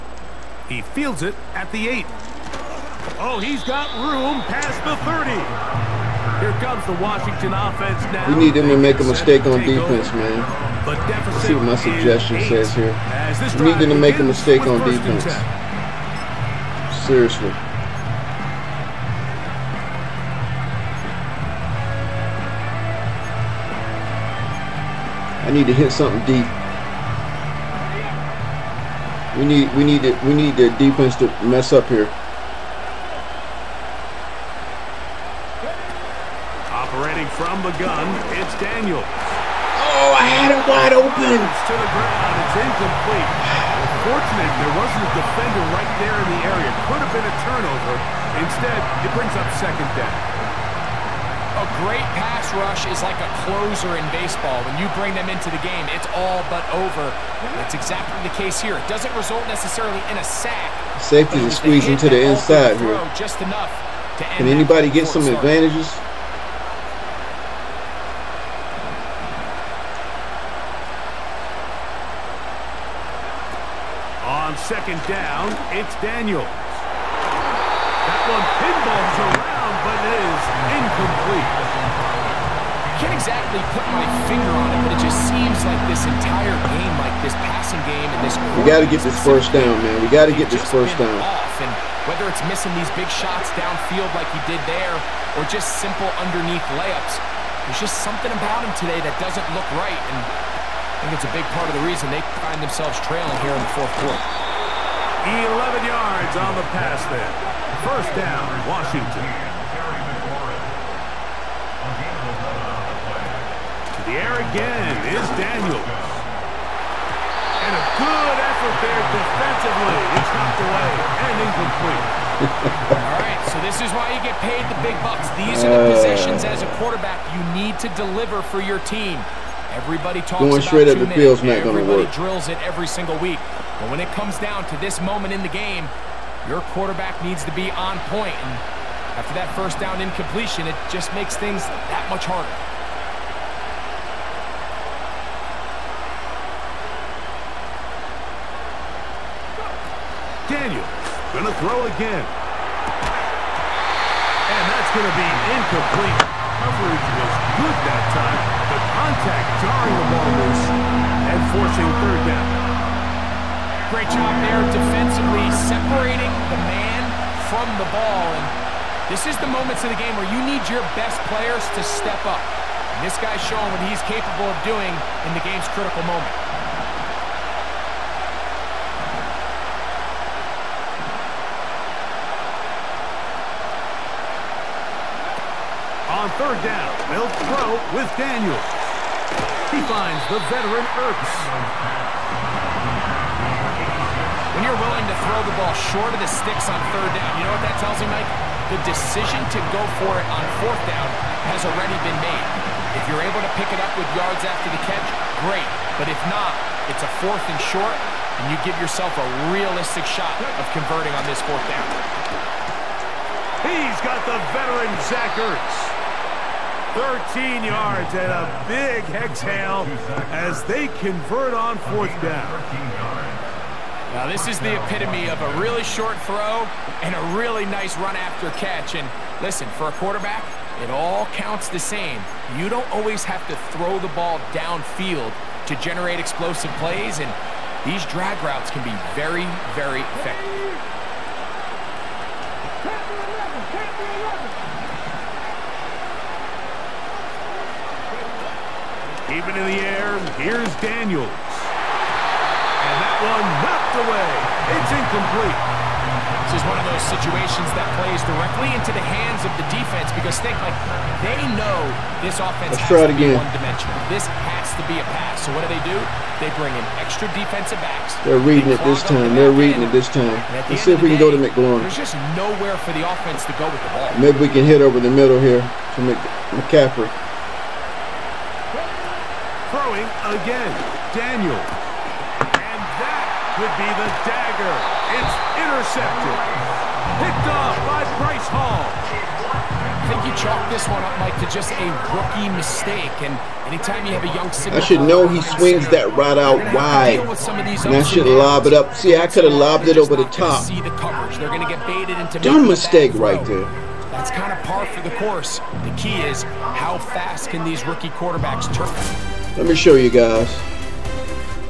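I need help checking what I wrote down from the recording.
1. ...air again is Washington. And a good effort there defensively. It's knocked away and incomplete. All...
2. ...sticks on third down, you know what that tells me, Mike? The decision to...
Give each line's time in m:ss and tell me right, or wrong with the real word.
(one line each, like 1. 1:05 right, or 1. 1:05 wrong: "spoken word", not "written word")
1. 1:54 wrong: "Daniels", not "Washington"
2. 3:16 right.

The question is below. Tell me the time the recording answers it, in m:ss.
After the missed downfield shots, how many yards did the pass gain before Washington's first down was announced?
1:45.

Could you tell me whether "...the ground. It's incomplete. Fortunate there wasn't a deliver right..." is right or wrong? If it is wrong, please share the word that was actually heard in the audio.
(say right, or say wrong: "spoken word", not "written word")
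wrong: "defender", not "deliver".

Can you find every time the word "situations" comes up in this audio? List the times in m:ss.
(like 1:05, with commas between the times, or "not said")
4:17.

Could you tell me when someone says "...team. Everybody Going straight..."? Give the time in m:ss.
2:08.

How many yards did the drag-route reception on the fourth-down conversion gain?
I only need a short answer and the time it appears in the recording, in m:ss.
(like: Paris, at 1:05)
13, at 3:37.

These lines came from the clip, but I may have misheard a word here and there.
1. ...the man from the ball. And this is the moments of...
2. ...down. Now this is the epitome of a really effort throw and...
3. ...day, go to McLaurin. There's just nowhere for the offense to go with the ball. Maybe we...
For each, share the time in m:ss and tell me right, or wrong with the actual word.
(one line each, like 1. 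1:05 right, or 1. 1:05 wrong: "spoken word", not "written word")
1. 2:46 right
2. 3:42 wrong: "short", not "effort"
3. 4:31 right.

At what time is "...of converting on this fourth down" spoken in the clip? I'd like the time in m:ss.
3:30.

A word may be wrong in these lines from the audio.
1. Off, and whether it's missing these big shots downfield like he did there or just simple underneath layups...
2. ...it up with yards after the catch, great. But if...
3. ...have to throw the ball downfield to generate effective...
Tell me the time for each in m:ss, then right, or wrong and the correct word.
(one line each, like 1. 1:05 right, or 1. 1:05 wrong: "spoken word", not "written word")
1. 1:31 right
2. 3:23 right
3. 3:53 wrong: "explosive", not "effective".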